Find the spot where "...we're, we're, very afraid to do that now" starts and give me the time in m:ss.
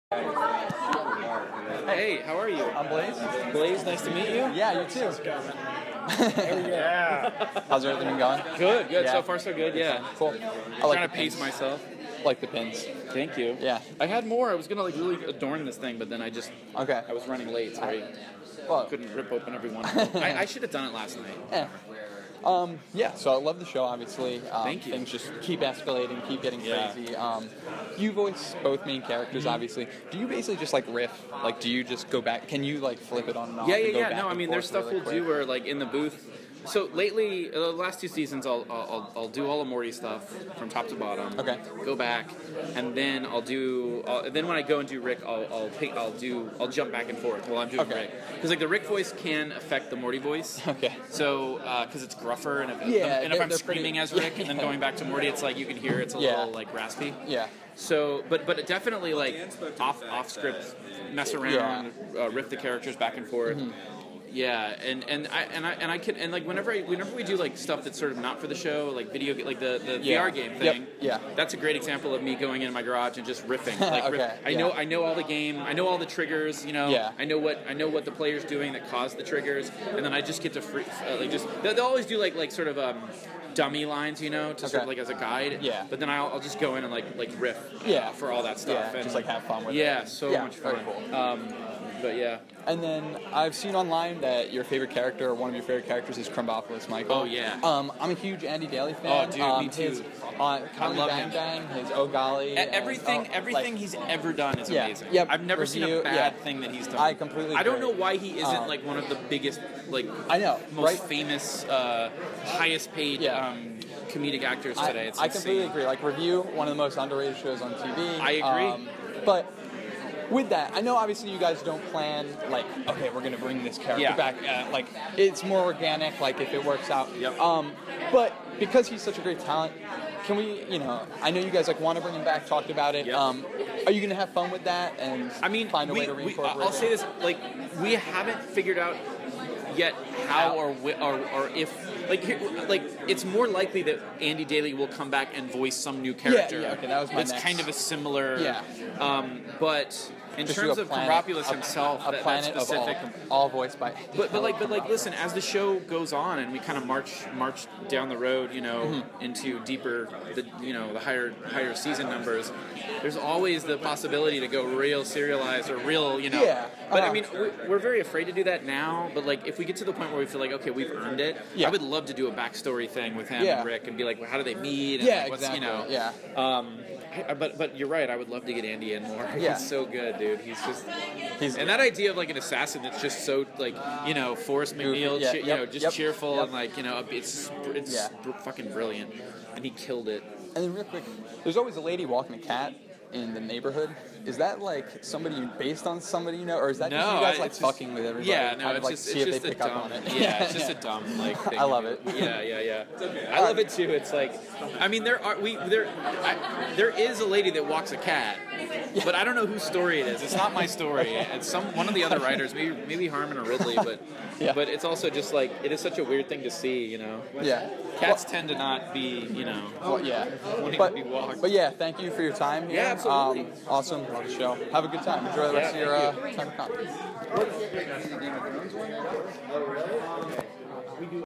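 2:47.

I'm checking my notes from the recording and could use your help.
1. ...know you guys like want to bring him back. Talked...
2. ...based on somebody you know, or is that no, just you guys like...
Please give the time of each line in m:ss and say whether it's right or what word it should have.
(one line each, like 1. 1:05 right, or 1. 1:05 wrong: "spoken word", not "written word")
1. 2:11 right
2. 3:15 right.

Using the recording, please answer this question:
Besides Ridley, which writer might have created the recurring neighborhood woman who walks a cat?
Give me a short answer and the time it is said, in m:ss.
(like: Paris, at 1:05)
Harmon, at 3:33.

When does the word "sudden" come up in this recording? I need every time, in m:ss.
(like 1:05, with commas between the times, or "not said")
not said.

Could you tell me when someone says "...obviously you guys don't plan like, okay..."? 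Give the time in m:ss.
2:00.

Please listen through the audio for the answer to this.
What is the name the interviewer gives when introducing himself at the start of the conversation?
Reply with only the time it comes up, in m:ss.
0:02.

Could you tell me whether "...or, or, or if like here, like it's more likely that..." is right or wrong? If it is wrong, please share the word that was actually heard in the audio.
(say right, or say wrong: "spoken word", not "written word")
right.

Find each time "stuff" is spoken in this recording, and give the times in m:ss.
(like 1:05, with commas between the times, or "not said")
0:34, 0:39, 1:07, 1:28.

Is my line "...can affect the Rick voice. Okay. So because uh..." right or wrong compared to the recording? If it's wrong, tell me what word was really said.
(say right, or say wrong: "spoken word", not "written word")
wrong: "Morty", not "Rick".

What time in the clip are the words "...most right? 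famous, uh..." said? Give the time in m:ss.
1:50.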